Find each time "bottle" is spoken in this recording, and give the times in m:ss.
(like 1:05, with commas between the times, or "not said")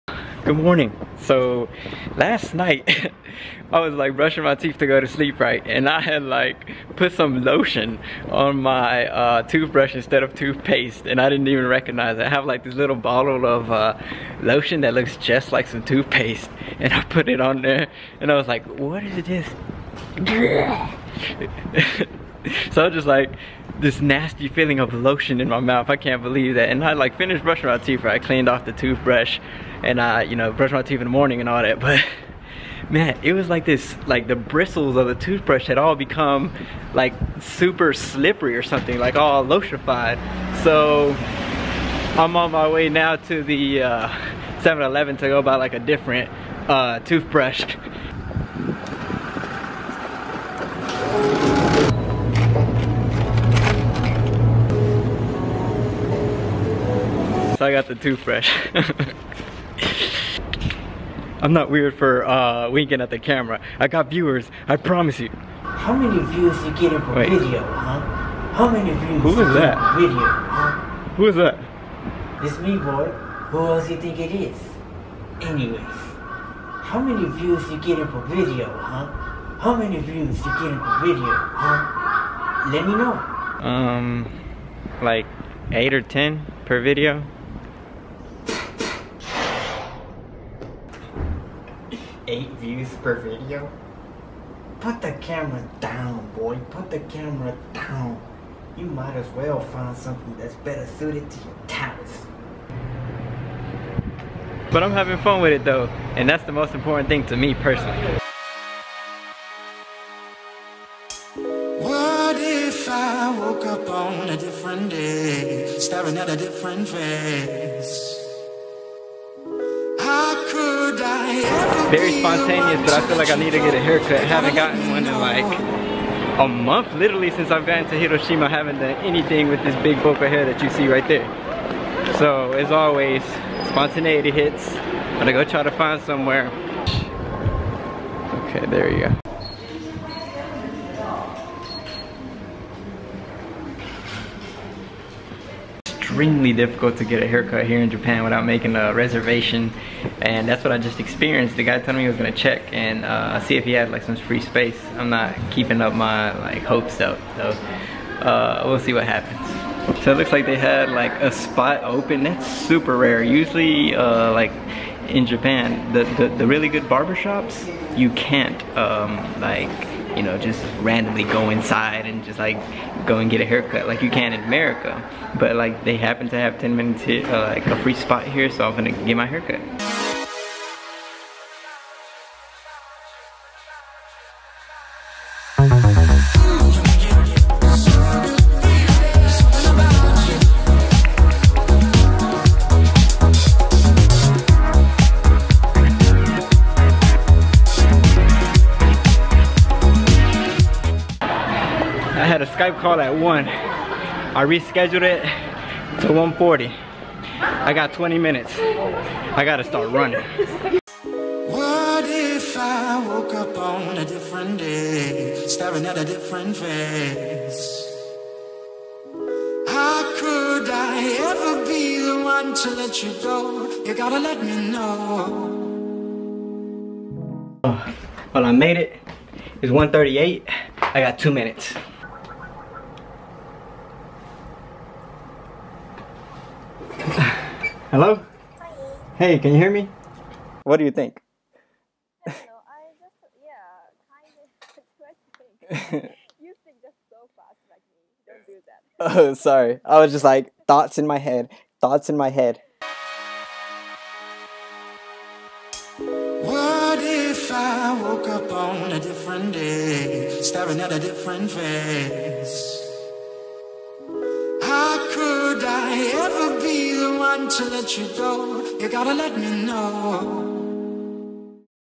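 0:12.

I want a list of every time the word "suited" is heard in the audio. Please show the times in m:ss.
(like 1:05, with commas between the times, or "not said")
1:40.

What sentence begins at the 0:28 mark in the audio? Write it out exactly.
I cleaned off the toothbrush and I, you know, brushed my teeth in the morning and all that.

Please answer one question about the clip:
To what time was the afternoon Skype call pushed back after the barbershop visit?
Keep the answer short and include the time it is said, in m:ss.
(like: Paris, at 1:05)
1:40, at 3:26.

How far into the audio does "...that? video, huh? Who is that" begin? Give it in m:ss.
1:09.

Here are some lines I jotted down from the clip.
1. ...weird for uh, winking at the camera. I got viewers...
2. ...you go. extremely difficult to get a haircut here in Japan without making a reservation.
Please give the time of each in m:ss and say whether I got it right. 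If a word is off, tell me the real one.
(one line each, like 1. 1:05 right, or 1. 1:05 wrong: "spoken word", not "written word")
1. 1:01 right
2. 2:18 right.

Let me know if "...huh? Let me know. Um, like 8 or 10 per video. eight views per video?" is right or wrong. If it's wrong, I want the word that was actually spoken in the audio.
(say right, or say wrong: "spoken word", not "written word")
right.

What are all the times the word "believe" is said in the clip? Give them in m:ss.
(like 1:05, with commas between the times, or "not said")
0:26.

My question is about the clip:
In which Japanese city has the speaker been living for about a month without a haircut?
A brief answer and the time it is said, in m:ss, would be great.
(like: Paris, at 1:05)
Hiroshima, at 2:07.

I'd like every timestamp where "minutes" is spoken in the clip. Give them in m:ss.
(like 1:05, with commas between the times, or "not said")
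2:56, 3:28, 3:51.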